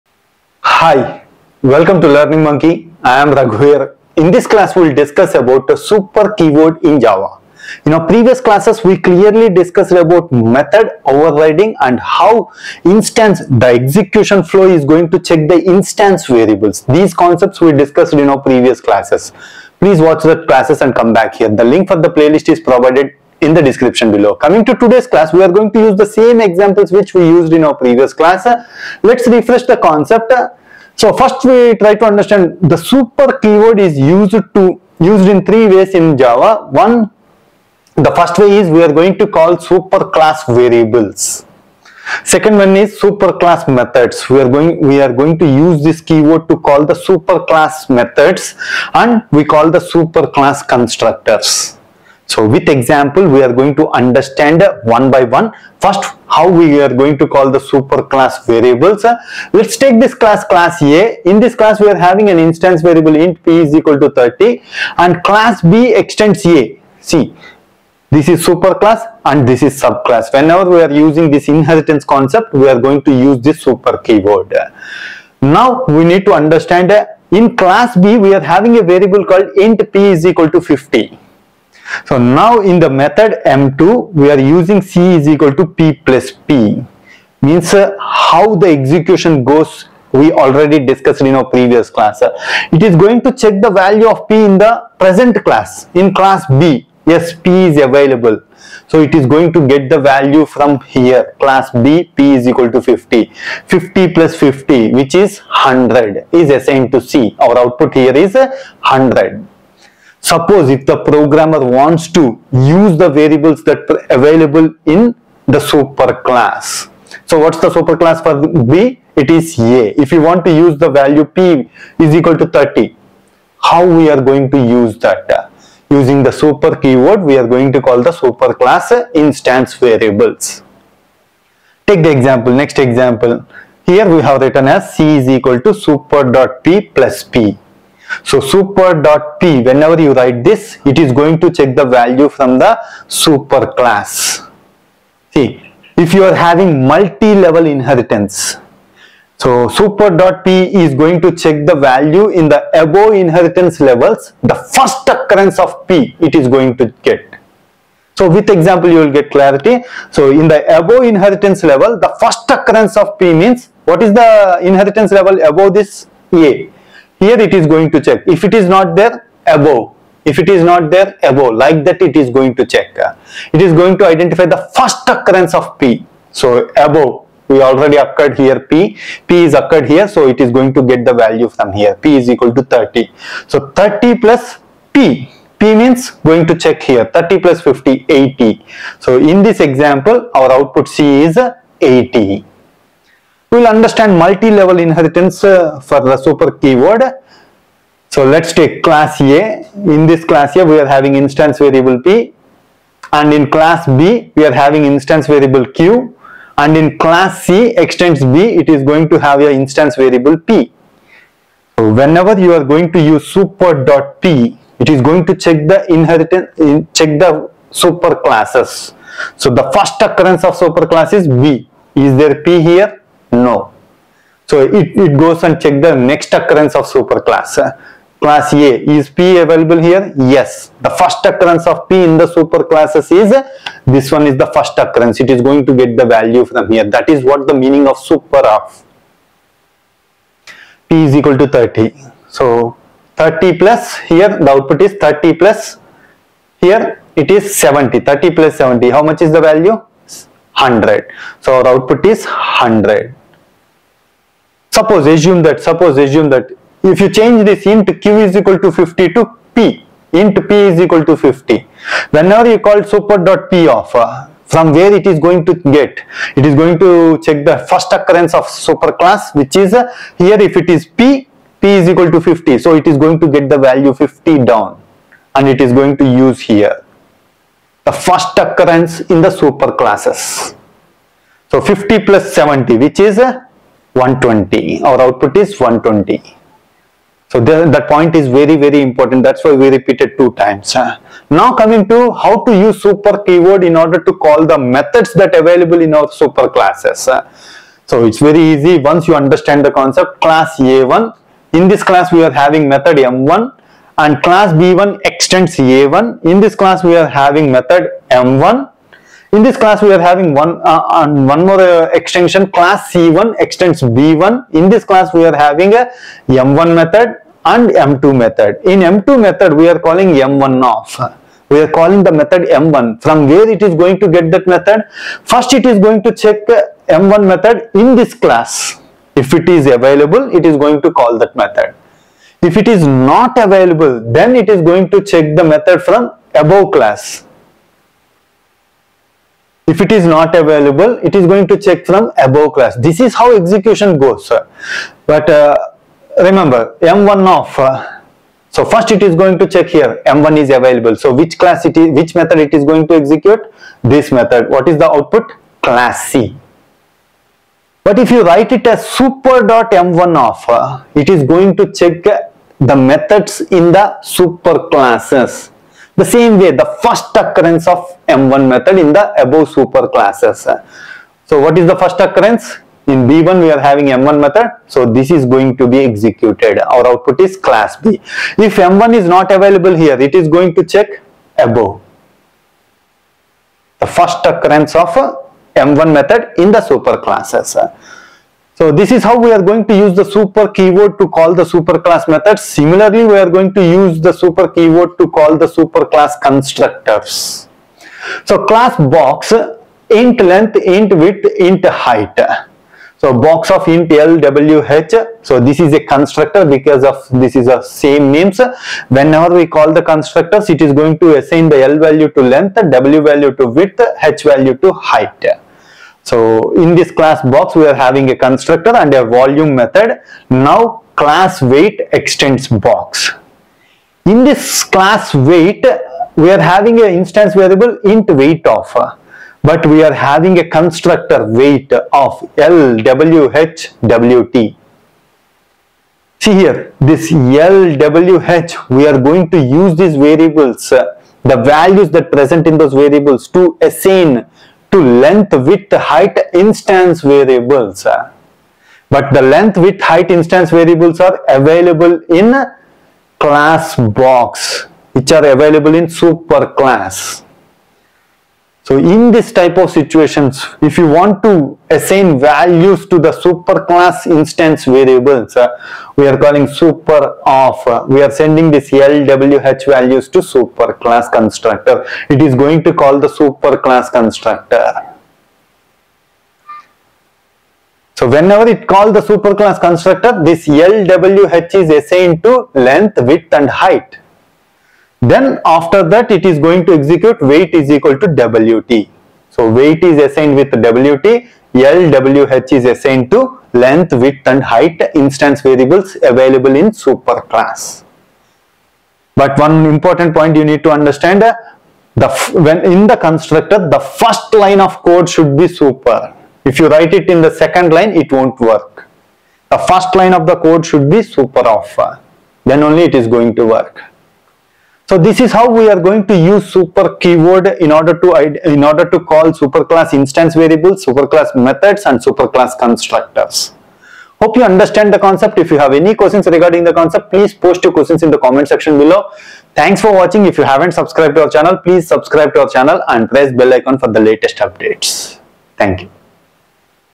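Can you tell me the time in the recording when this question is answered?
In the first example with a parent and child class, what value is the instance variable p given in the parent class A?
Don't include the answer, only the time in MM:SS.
01:03.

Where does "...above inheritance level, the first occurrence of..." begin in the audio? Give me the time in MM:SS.
02:40.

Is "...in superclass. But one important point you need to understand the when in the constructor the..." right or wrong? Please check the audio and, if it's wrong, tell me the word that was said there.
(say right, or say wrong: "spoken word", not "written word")
right.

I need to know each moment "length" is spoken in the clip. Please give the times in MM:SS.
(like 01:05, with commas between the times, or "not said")
06:40, 06:52, 07:24, 07:29, 08:02, 08:13.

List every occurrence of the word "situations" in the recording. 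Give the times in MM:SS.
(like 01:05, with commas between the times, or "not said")
07:39.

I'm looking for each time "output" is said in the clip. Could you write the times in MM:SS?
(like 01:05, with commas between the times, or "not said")
01:47, 03:10, 04:04, 04:11, 04:45, 05:54, 06:16.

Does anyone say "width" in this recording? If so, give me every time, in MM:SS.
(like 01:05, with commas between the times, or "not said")
06:40, 06:53, 07:25, 07:29, 08:03, 08:13.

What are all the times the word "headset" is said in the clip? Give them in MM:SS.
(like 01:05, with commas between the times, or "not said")
not said.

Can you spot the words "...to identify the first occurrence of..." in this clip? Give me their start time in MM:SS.
02:54.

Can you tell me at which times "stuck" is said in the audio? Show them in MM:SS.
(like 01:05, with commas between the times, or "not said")
not said.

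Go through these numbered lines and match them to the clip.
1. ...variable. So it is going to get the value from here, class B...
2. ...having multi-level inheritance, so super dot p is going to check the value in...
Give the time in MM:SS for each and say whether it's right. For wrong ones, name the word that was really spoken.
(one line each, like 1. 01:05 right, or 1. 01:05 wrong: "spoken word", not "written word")
1. 01:37 wrong: "available", not "variable"
2. 02:26 right.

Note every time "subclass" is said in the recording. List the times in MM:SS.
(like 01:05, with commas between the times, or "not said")
01:09.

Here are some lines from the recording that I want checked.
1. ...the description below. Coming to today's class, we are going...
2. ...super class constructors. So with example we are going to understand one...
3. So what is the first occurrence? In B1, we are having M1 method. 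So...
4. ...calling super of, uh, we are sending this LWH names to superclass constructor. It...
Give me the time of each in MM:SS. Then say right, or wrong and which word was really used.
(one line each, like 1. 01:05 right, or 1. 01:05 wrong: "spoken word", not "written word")
1. 00:23 right
2. 00:49 right
3. 06:11 right
4. 07:46 wrong: "values", not "names".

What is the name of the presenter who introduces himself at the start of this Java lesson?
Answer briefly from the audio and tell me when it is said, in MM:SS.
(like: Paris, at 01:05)
Raghu, at 00:03.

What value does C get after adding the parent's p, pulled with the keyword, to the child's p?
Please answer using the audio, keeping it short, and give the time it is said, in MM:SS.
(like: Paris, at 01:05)
80, at 03:10.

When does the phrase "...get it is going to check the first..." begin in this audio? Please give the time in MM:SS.
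04:25.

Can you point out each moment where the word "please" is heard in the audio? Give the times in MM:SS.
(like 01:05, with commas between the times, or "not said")
00:19, 08:47, 08:51.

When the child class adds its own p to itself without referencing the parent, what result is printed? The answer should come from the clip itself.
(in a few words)
100.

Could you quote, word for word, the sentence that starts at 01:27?
Means uh, how the execution goes, we already discussed in our previous class.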